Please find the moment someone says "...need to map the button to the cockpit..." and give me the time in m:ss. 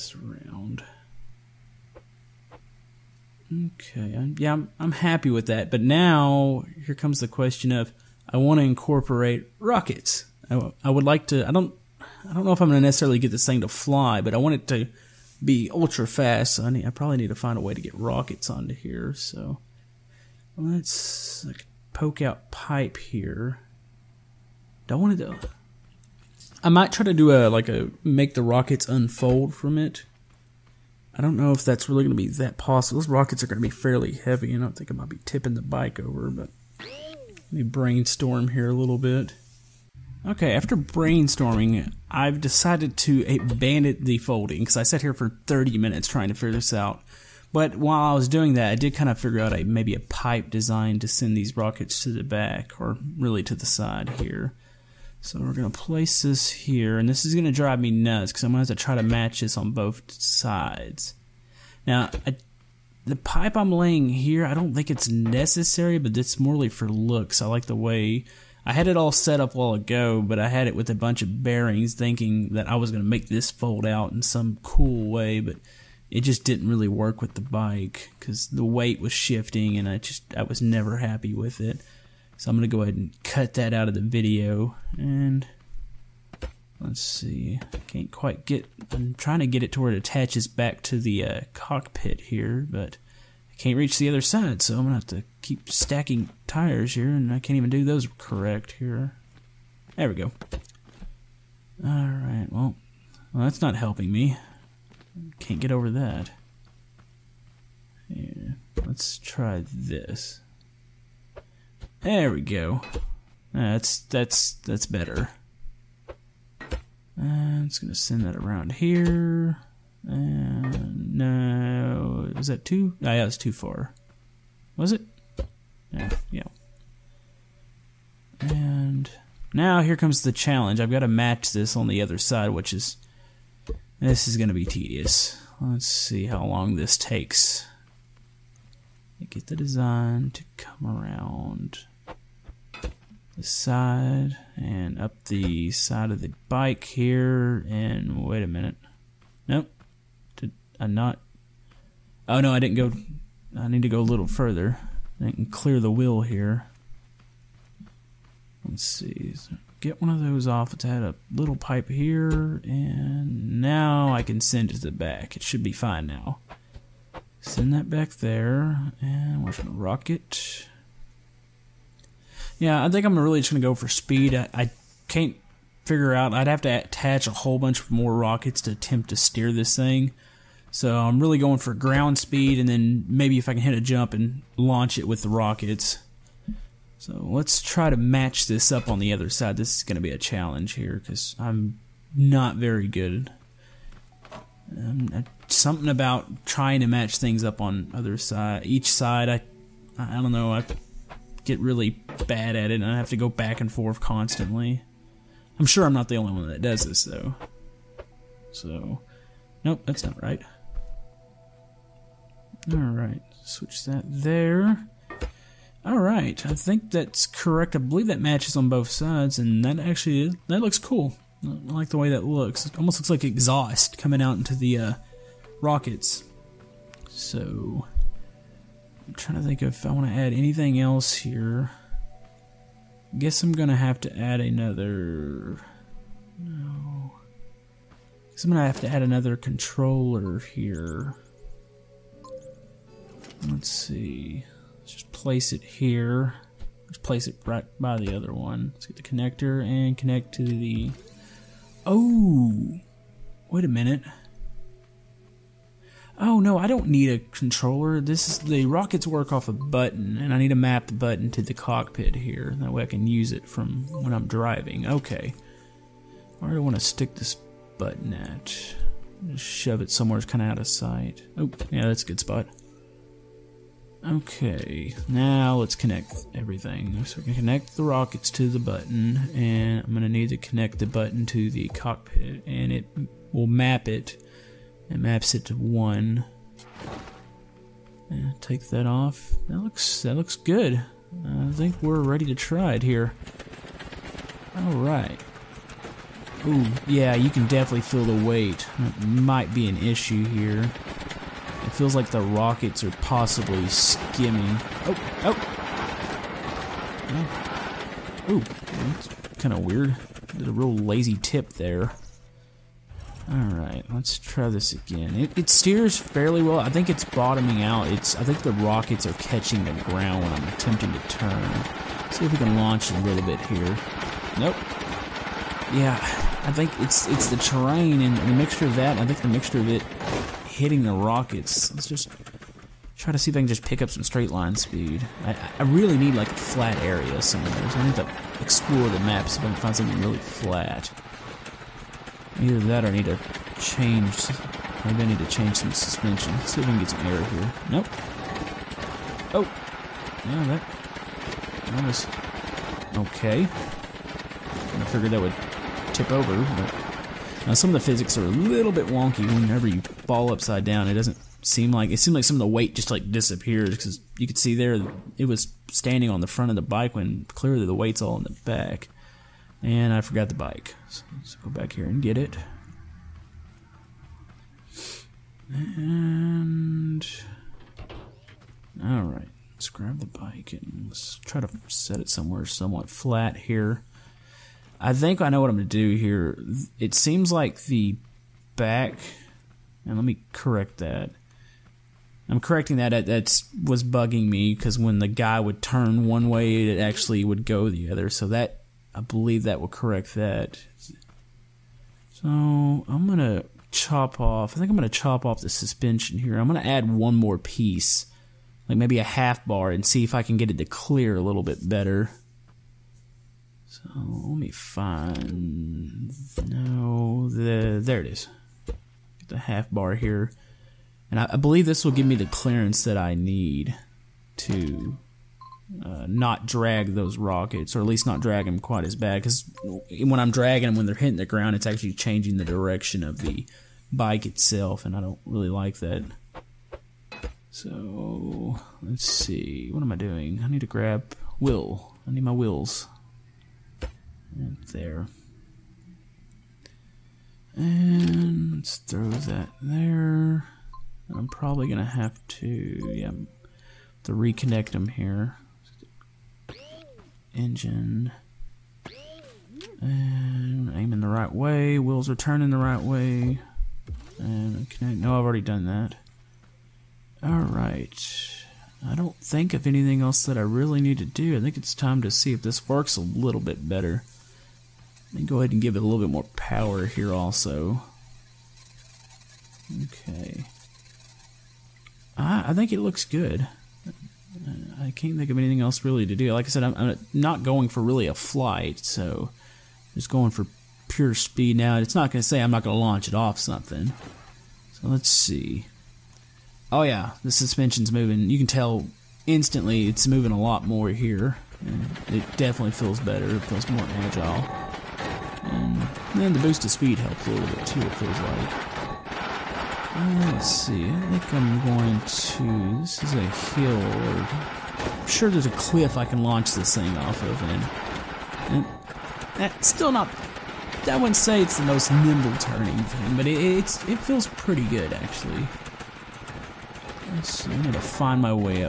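4:20.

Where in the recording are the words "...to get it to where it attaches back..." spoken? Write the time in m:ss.
1:29.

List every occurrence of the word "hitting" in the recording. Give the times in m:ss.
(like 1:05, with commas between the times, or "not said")
5:30, 7:10.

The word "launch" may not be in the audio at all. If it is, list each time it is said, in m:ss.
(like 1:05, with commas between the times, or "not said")
3:04, 5:22, 8:12, 8:36.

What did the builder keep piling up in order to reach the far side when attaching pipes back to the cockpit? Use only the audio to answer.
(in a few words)
tires.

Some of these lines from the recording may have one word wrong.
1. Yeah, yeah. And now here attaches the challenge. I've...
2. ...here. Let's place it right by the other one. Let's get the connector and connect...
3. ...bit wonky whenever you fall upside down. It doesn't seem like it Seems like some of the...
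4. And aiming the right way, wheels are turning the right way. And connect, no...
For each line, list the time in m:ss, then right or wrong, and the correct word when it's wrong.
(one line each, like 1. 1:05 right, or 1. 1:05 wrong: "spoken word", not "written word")
1. 2:05 wrong: "comes", not "attaches"
2. 4:05 right
3. 5:58 right
4. 7:39 right.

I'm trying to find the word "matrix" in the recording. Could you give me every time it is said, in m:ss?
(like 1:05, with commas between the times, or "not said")
not said.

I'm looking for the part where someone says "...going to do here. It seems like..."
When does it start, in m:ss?
6:25.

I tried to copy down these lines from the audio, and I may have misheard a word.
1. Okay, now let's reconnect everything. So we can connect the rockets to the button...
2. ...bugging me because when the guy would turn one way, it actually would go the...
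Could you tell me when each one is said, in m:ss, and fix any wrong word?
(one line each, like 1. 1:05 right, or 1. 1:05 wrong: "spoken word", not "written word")
1. 4:34 wrong: "connect", not "reconnect"
2. 6:33 right.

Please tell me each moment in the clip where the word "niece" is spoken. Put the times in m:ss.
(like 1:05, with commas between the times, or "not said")
not said.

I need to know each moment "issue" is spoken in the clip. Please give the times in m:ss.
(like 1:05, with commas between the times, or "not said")
4:59.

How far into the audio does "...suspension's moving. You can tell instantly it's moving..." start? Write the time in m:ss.
8:17.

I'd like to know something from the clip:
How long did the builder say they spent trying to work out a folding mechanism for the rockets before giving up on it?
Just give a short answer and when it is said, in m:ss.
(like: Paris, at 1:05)
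30 minutes, at 0:45.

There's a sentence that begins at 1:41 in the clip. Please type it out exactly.
Alright, well, well, that's not helping me.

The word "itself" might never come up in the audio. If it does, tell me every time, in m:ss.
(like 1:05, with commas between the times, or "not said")
7:14.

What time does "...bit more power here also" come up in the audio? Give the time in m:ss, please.
7:55.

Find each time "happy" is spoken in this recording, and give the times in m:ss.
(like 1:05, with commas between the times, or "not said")
0:04, 1:20.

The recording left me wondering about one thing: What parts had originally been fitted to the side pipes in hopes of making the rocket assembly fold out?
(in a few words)
bearings.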